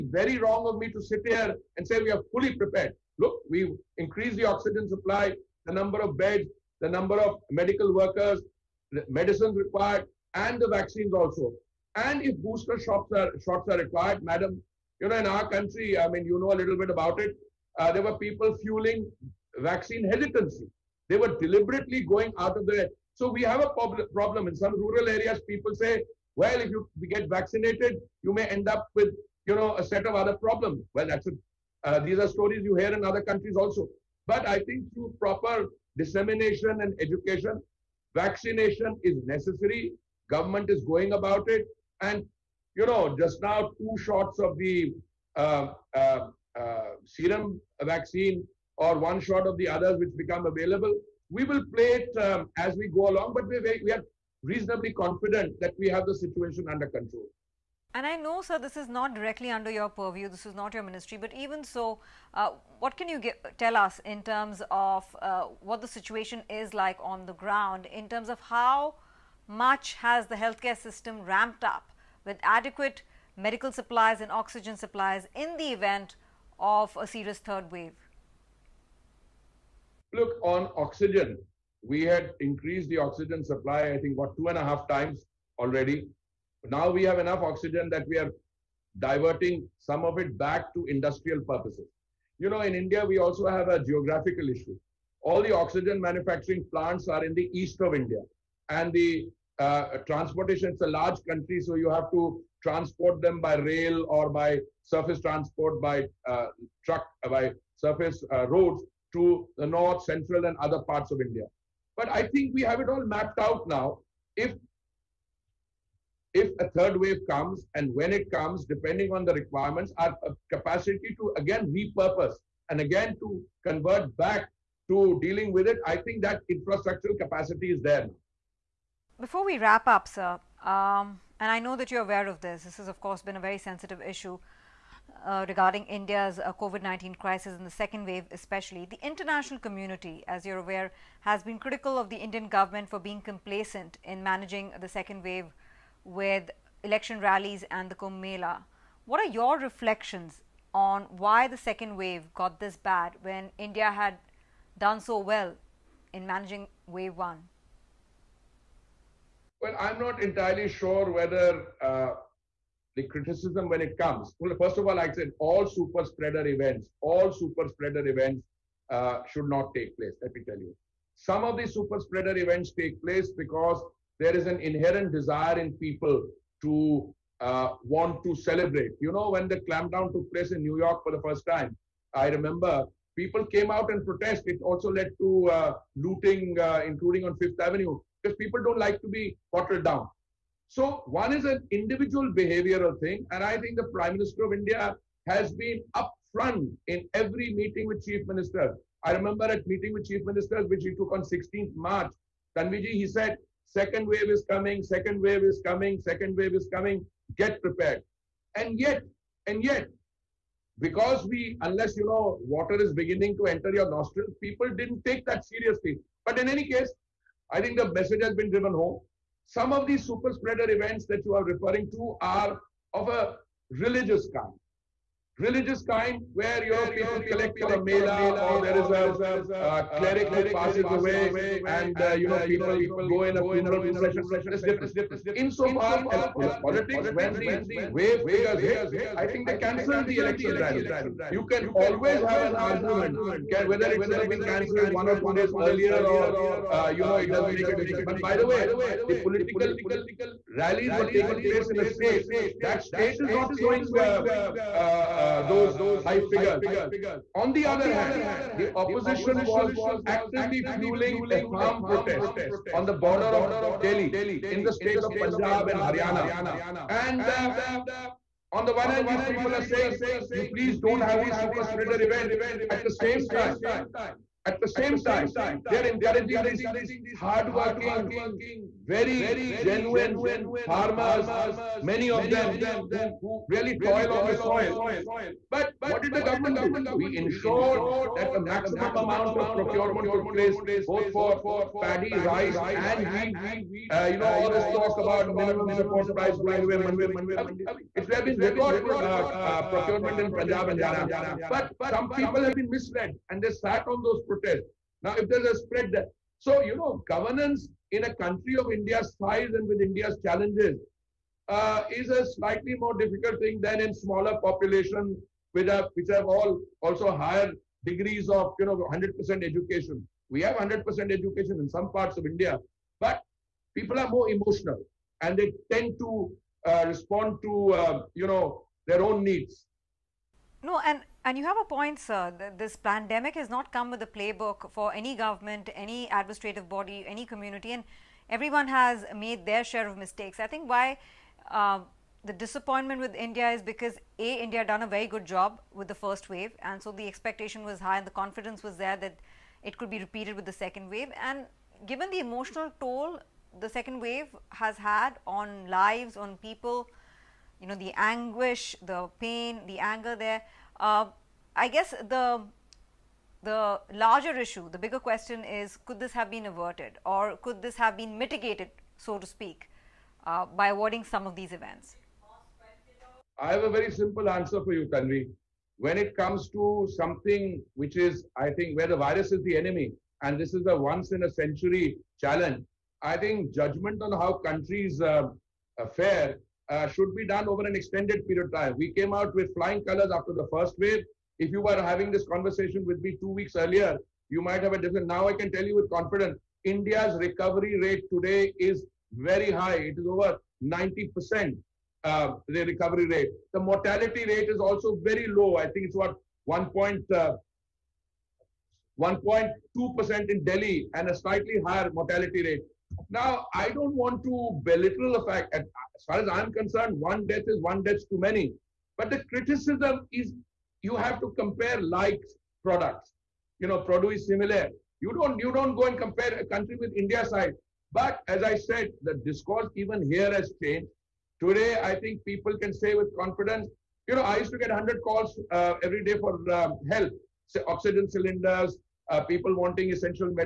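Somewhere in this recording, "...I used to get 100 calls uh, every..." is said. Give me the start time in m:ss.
7:14.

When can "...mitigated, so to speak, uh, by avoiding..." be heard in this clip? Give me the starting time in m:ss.
6:08.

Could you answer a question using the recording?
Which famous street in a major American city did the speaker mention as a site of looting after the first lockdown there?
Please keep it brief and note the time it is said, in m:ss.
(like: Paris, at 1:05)
Fifth Avenue, at 3:07.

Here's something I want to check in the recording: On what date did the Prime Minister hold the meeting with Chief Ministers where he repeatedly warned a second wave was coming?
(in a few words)
16 March.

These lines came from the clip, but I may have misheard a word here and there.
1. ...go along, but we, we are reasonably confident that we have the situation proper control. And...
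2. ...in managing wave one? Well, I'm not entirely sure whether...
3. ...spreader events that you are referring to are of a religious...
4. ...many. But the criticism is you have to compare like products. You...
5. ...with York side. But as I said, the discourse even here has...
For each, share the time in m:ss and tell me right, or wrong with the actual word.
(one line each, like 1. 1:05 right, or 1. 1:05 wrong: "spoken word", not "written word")
1. 0:52 wrong: "under", not "proper"
2. 2:36 right
3. 3:40 right
4. 6:58 right
5. 7:06 wrong: "India", not "York".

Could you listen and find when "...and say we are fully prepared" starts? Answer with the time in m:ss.
0:01.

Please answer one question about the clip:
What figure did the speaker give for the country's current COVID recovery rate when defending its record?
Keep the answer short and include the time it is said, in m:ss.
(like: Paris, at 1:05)
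over 90%, at 6:40.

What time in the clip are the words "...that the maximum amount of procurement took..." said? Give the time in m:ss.
4:48.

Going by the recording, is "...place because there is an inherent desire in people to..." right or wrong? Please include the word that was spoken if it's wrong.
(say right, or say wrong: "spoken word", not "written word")
right.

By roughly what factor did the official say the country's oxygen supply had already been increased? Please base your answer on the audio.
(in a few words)
2.5 times.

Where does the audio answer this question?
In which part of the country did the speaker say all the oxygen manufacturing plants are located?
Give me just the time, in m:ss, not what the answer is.
1:37.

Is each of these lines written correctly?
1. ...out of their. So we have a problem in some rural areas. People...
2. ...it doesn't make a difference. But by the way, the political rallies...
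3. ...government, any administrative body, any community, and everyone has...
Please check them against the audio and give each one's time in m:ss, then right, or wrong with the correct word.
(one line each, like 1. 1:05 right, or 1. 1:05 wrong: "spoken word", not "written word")
1. 0:22 right
2. 4:07 right
3. 5:35 right.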